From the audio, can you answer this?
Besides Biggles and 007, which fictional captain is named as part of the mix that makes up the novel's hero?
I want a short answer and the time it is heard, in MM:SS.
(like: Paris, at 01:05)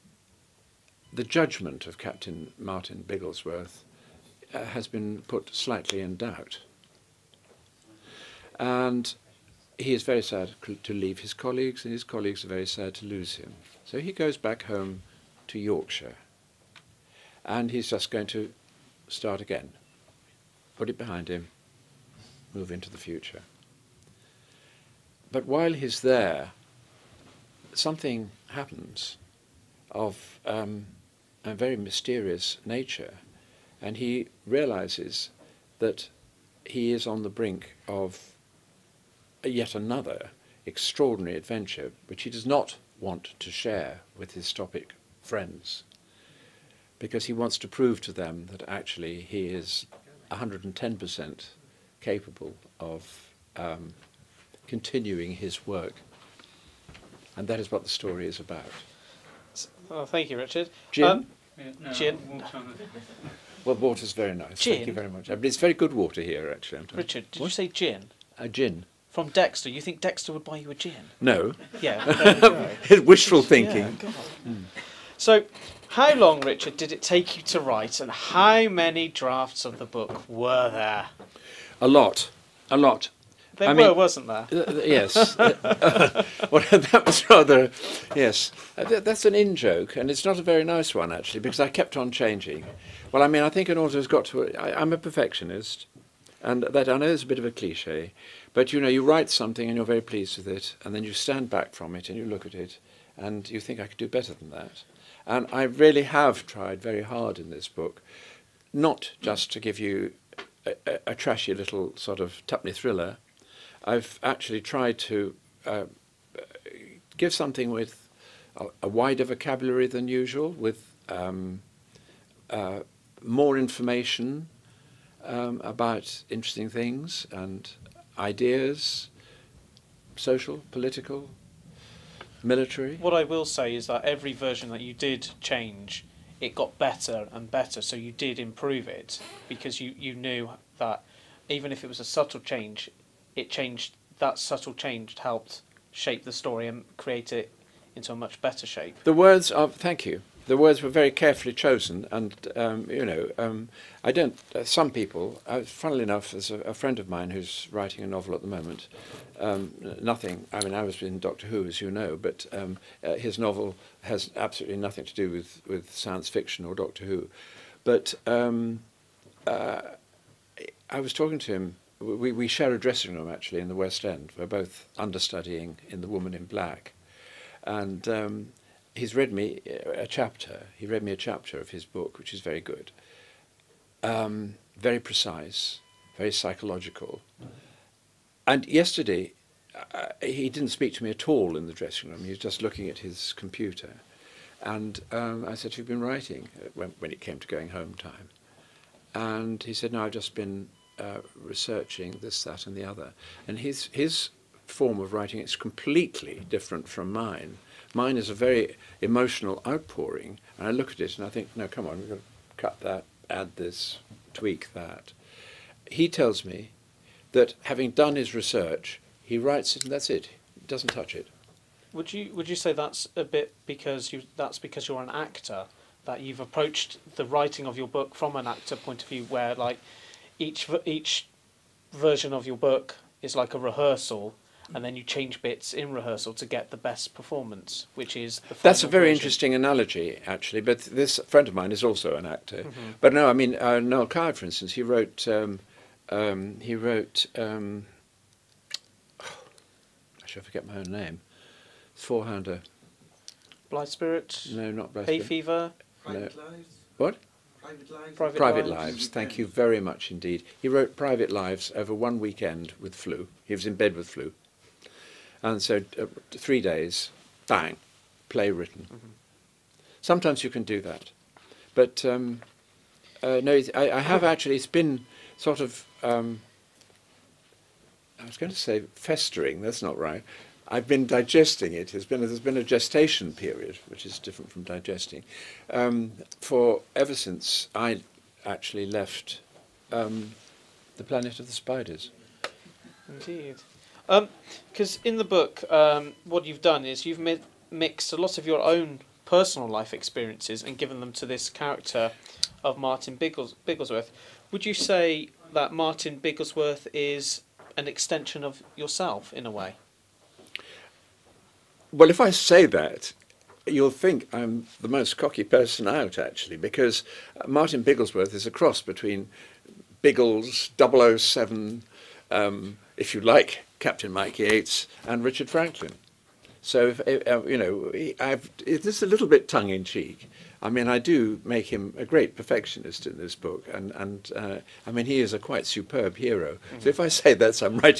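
Captain Mike Yates, at 05:23.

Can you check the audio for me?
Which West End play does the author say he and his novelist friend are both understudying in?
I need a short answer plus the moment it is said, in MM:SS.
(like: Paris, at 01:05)
The Woman in Black, at 02:56.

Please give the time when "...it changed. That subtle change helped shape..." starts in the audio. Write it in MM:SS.
02:23.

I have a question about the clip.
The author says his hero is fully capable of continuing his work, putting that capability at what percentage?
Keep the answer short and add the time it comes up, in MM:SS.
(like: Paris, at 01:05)
110%, at 00:50.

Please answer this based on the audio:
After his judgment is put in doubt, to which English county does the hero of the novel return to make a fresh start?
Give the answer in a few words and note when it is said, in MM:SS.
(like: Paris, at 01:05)
Yorkshire, at 00:15.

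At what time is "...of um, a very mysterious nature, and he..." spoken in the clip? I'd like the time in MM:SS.
00:29.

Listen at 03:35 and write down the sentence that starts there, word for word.
He tells me that having done his research, he writes it and that's it.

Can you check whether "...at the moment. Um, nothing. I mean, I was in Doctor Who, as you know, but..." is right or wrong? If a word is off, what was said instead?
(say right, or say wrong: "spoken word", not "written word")
right.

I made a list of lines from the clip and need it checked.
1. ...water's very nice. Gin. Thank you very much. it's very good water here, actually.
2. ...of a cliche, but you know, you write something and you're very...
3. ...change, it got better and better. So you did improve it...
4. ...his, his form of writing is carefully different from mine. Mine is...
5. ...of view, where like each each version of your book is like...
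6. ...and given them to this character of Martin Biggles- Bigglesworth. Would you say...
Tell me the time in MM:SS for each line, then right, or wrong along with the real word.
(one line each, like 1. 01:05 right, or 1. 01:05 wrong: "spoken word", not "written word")
1. 01:03 right
2. 01:37 right
3. 02:15 right
4. 03:23 wrong: "completely", not "carefully"
5. 03:49 right
6. 05:00 right.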